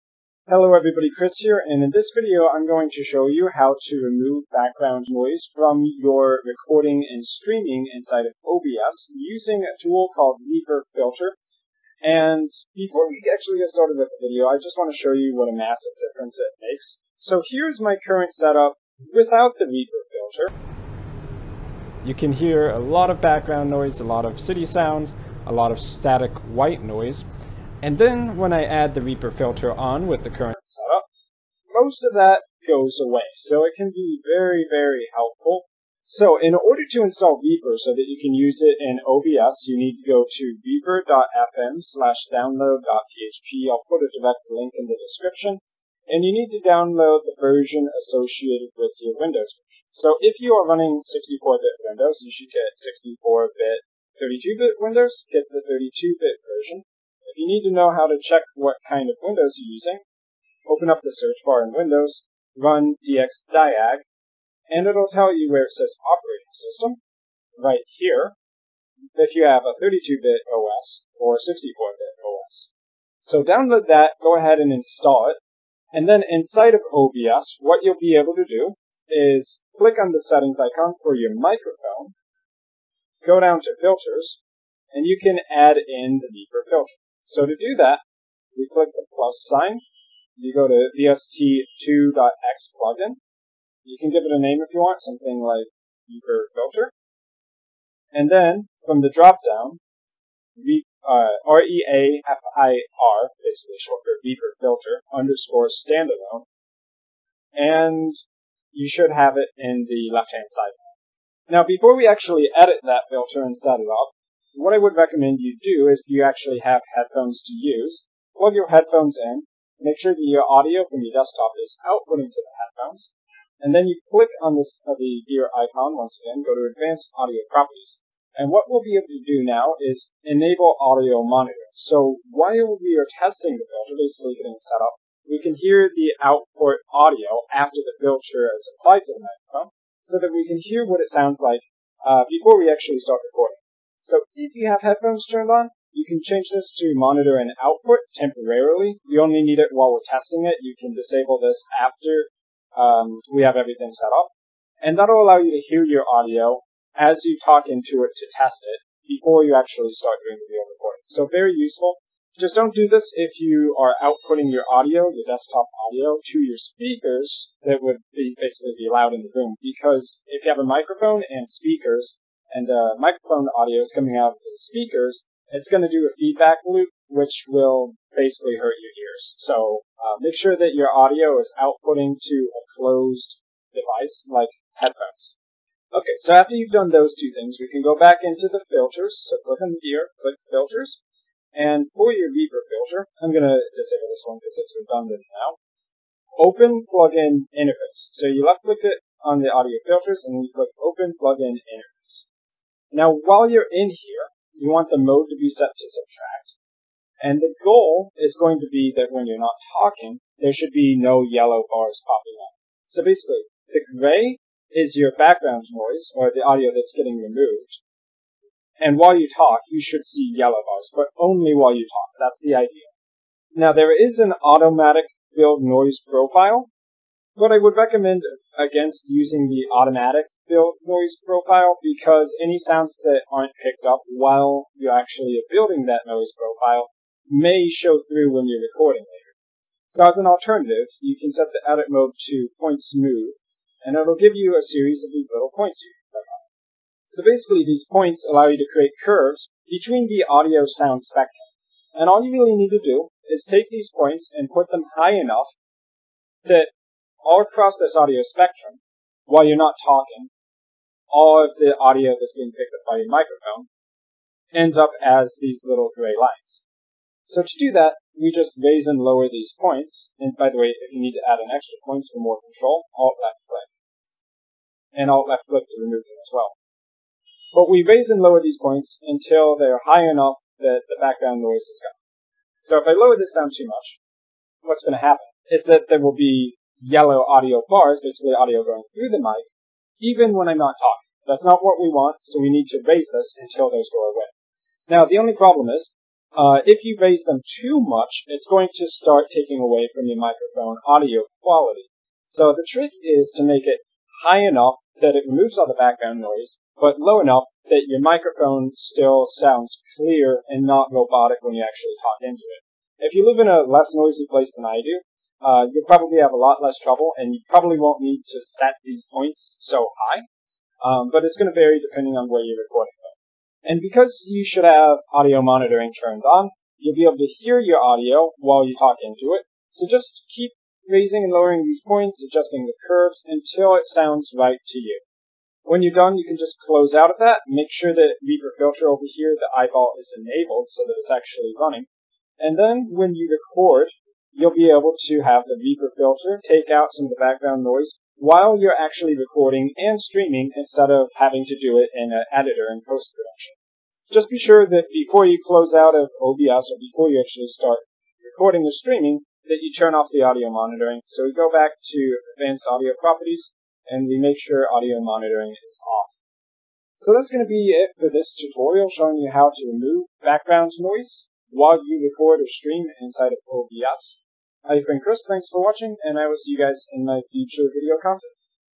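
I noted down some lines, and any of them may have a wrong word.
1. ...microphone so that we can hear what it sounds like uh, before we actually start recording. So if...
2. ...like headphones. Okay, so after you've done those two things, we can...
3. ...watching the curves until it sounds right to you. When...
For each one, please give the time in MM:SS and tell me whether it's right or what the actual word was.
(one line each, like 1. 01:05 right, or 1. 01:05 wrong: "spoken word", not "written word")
1. 02:19 right
2. 03:04 right
3. 05:32 wrong: "adjusting", not "watching".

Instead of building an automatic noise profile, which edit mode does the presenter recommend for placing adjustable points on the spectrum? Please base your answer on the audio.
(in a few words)
point smooth.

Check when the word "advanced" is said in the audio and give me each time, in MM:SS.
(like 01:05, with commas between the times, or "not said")
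02:06, 06:02.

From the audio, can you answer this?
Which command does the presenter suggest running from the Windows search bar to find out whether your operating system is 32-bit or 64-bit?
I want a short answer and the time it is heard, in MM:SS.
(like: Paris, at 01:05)
dxdiag, at 01:03.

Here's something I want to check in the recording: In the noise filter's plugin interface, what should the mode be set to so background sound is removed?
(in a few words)
subtract.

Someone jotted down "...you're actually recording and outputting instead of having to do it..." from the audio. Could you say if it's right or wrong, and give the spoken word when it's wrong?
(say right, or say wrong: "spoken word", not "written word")
wrong: "streaming", not "outputting".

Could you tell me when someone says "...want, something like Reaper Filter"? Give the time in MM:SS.
01:34.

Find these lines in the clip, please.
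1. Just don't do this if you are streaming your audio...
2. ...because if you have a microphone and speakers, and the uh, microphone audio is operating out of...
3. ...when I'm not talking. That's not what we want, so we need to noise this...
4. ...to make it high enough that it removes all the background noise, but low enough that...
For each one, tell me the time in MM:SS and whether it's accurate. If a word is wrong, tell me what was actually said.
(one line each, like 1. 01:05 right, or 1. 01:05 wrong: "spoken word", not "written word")
1. 02:42 wrong: "outputting", not "streaming"
2. 02:49 wrong: "coming", not "operating"
3. 04:50 wrong: "raise", not "noise"
4. 05:03 right.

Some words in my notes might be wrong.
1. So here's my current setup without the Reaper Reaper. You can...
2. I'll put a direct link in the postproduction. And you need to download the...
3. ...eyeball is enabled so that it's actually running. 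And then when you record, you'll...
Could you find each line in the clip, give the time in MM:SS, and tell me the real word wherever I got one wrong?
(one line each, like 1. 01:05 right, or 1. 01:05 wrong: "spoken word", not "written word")
1. 00:17 wrong: "Filter", not "Reaper"
2. 00:43 wrong: "description", not "postproduction"
3. 05:39 right.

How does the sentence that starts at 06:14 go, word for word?
I've been Chris, thanks for watching, and I will see you guys in my future video content.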